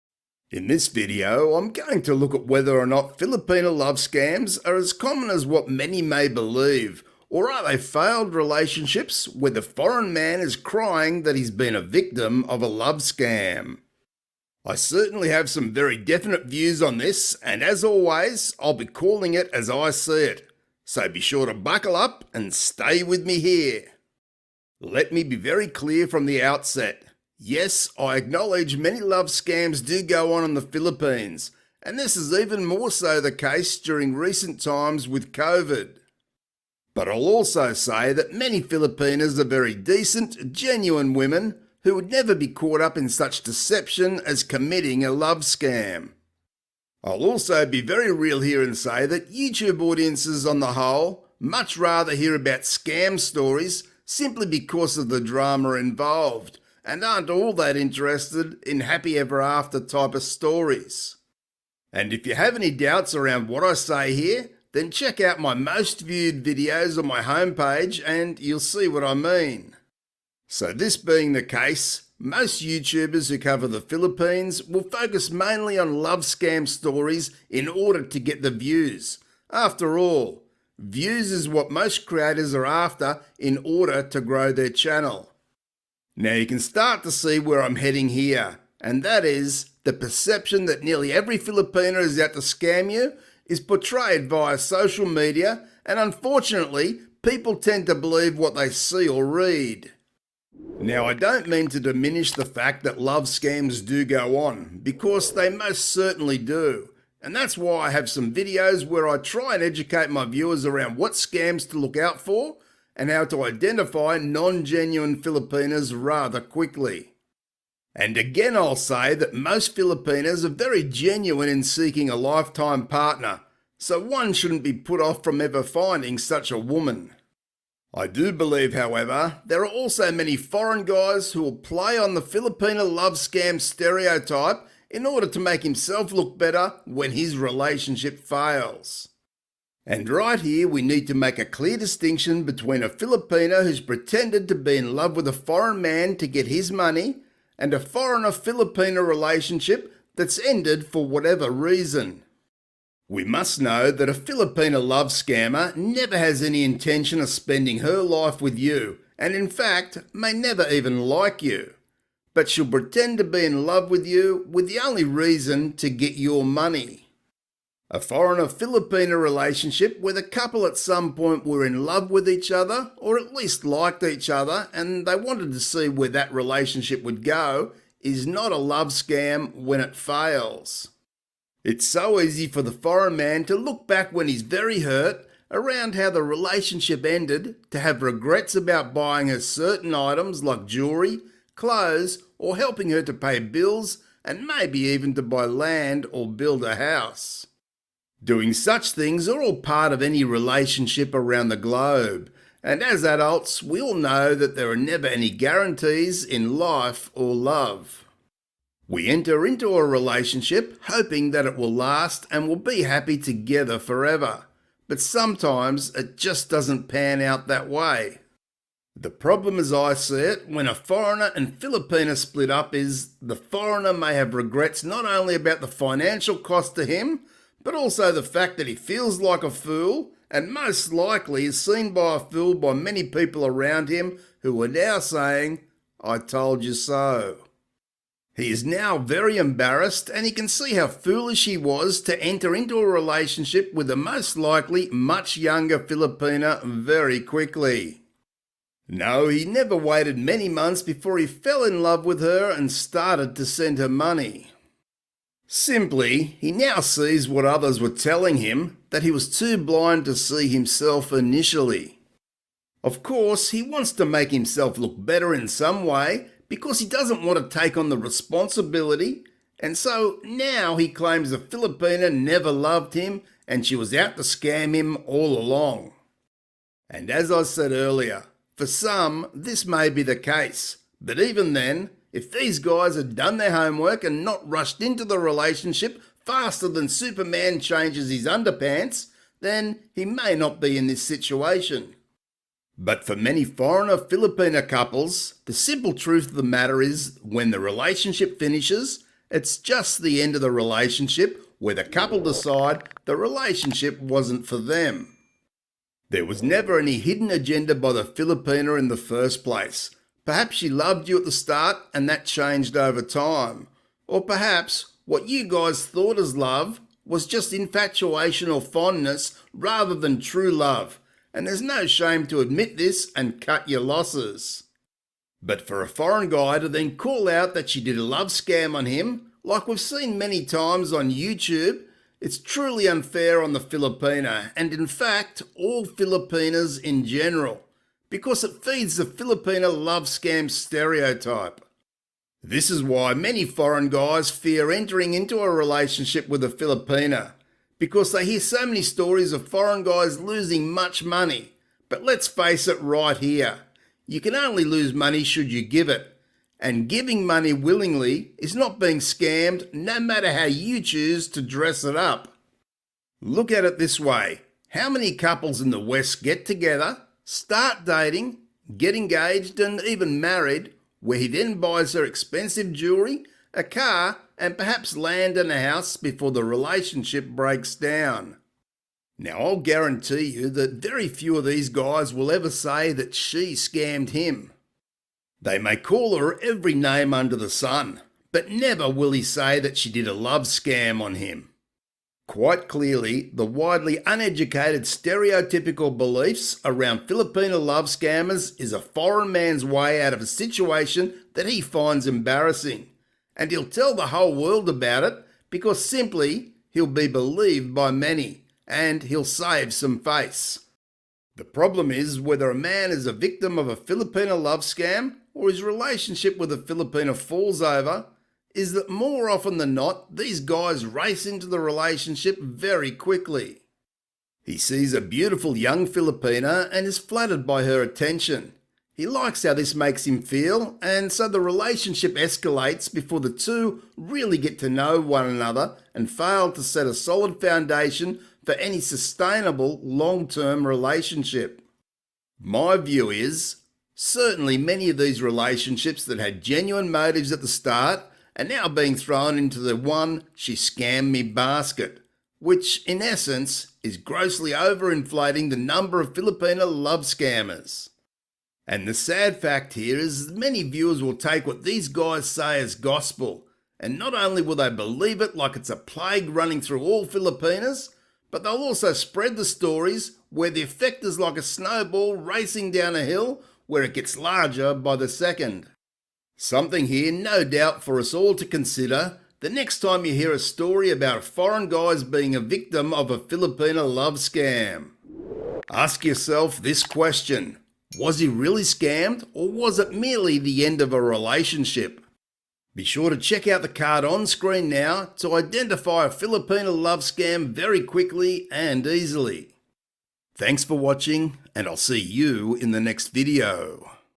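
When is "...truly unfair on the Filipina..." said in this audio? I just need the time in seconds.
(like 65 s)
332 s.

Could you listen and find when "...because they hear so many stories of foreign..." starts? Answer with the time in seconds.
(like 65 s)
347 s.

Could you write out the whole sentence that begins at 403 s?
And he'll tell the whole world about it because simply he'll be believed by many and he'll save some face.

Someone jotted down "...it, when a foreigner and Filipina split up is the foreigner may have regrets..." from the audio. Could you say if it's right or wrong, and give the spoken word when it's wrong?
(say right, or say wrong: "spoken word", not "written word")
right.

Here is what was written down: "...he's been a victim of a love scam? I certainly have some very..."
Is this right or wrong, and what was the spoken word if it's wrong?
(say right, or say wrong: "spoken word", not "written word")
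right.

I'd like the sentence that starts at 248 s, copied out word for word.
No, he never waited many months before he fell in love with her and started to send her money.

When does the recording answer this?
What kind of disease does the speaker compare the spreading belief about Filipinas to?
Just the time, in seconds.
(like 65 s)
465 s.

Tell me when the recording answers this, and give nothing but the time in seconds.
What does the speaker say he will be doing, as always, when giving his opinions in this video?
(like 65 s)
18 s.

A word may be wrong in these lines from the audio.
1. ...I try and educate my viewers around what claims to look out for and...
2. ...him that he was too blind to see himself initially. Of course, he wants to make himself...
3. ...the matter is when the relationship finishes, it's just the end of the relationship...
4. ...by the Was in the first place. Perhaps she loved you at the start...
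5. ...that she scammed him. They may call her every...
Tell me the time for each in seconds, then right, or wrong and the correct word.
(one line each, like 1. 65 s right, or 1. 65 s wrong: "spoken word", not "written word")
1. 109 s wrong: "scams", not "claims"
2. 258 s right
3. 296 s right
4. 307 s wrong: "Filipina", not "Was"
5. 382 s right.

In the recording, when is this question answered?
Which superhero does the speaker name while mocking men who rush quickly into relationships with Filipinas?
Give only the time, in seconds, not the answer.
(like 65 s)
286 s.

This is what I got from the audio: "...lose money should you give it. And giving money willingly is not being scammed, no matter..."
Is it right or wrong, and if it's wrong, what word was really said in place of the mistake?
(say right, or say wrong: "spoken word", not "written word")
right.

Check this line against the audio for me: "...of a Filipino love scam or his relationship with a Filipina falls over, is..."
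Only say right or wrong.
right.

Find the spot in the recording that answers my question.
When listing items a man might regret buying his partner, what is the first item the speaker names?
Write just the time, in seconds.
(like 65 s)
190 s.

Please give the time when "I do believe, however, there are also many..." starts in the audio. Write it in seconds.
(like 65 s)
127 s.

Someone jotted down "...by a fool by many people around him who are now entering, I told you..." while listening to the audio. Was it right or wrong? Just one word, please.
wrong.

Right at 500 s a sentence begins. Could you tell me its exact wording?
Thanks for watching, and I'll see you in the next video.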